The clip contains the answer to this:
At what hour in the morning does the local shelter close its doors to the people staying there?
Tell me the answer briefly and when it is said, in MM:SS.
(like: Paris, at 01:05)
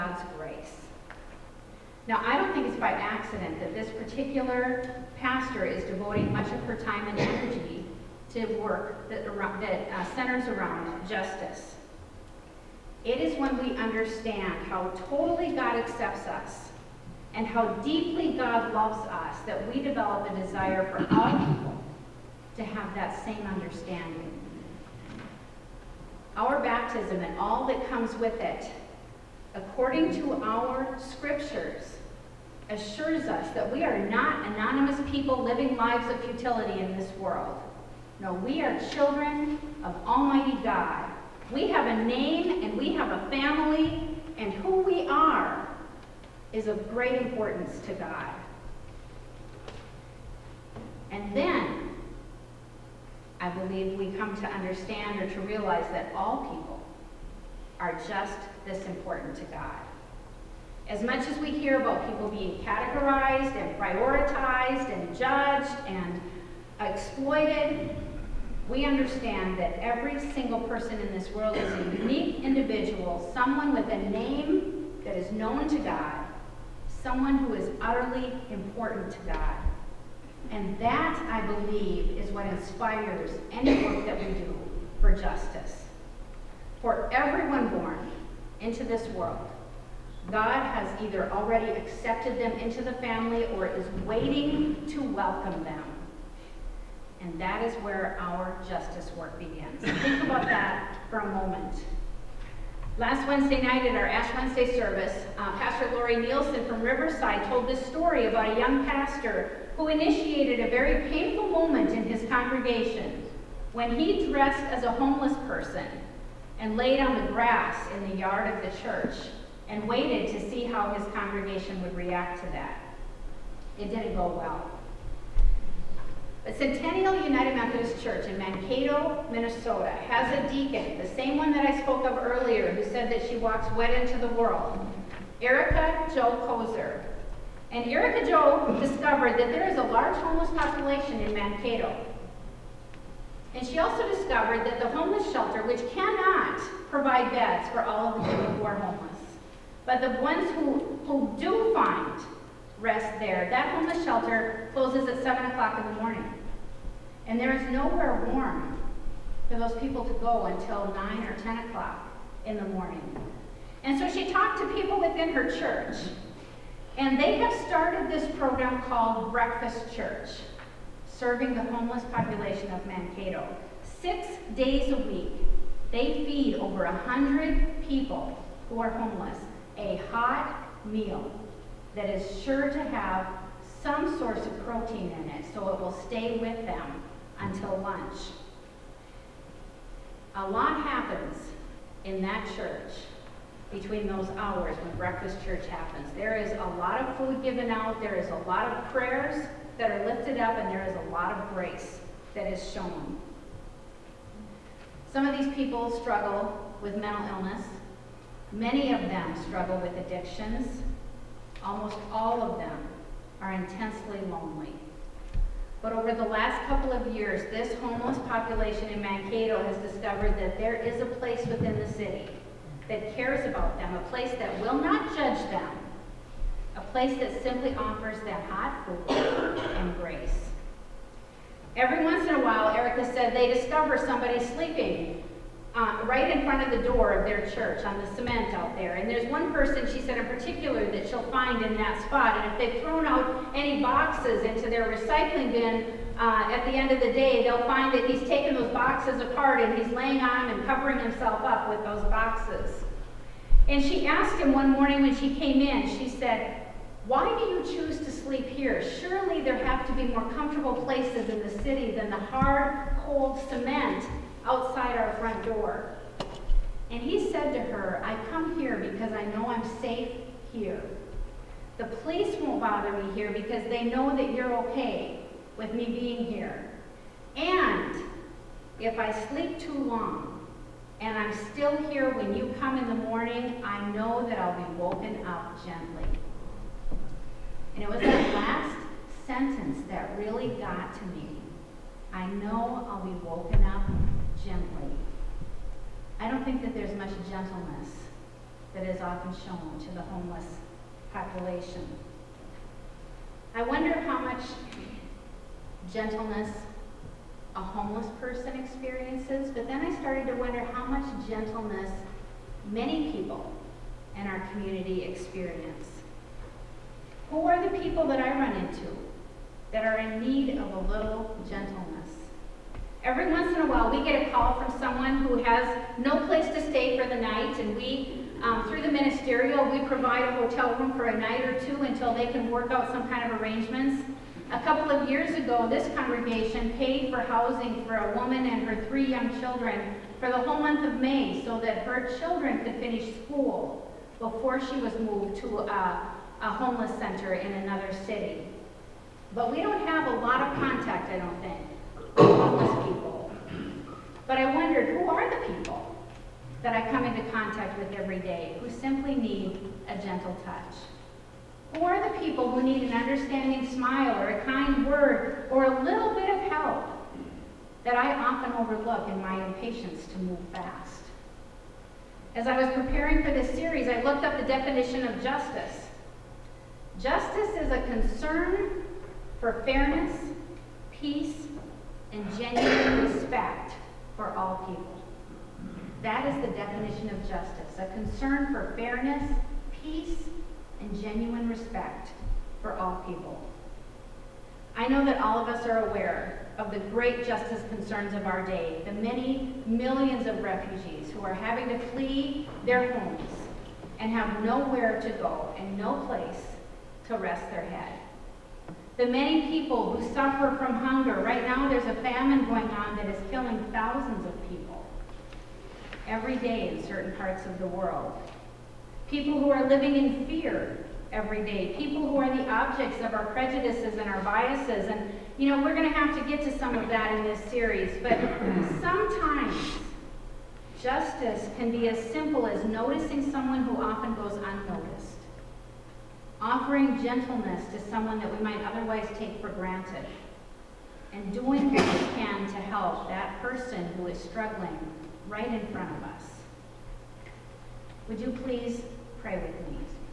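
7 o'clock, at 02:35.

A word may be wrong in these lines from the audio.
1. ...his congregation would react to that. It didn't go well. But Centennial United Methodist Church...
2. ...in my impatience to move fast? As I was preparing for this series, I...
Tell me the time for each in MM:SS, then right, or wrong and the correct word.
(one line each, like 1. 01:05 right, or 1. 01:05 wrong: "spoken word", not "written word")
1. 02:00 right
2. 06:09 right.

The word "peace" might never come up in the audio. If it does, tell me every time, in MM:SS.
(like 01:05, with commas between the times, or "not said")
06:20, 06:29.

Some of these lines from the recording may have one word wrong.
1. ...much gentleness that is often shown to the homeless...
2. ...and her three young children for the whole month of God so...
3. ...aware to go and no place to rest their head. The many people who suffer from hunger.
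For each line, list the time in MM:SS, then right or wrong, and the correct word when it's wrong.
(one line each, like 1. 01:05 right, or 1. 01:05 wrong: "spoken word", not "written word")
1. 04:56 right
2. 05:38 wrong: "May", not "God"
3. 06:44 wrong: "nowhere", not "aware".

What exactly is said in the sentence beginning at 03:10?
A lot happens in that church between those hours when breakfast church happens.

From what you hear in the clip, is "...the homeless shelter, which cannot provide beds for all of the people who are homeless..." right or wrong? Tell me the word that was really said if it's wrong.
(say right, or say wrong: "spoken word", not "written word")
right.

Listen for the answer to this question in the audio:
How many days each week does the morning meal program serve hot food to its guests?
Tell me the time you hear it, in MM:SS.
02:53.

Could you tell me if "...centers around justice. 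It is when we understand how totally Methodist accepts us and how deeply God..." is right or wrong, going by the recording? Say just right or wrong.
wrong.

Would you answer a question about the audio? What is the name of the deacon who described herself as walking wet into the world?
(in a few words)
Erica Jo Kozer.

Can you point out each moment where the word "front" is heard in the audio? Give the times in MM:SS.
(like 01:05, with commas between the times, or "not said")
03:56, 04:25, 07:25.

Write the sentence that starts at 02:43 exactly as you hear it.
And so she talked to people within her church.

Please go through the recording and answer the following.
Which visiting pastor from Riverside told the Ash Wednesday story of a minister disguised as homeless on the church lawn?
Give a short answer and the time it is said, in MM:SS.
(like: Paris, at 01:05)
Lori Nielsen, at 01:45.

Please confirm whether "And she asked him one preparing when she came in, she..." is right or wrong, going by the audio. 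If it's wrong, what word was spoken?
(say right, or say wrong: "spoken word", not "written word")
wrong: "morning", not "preparing".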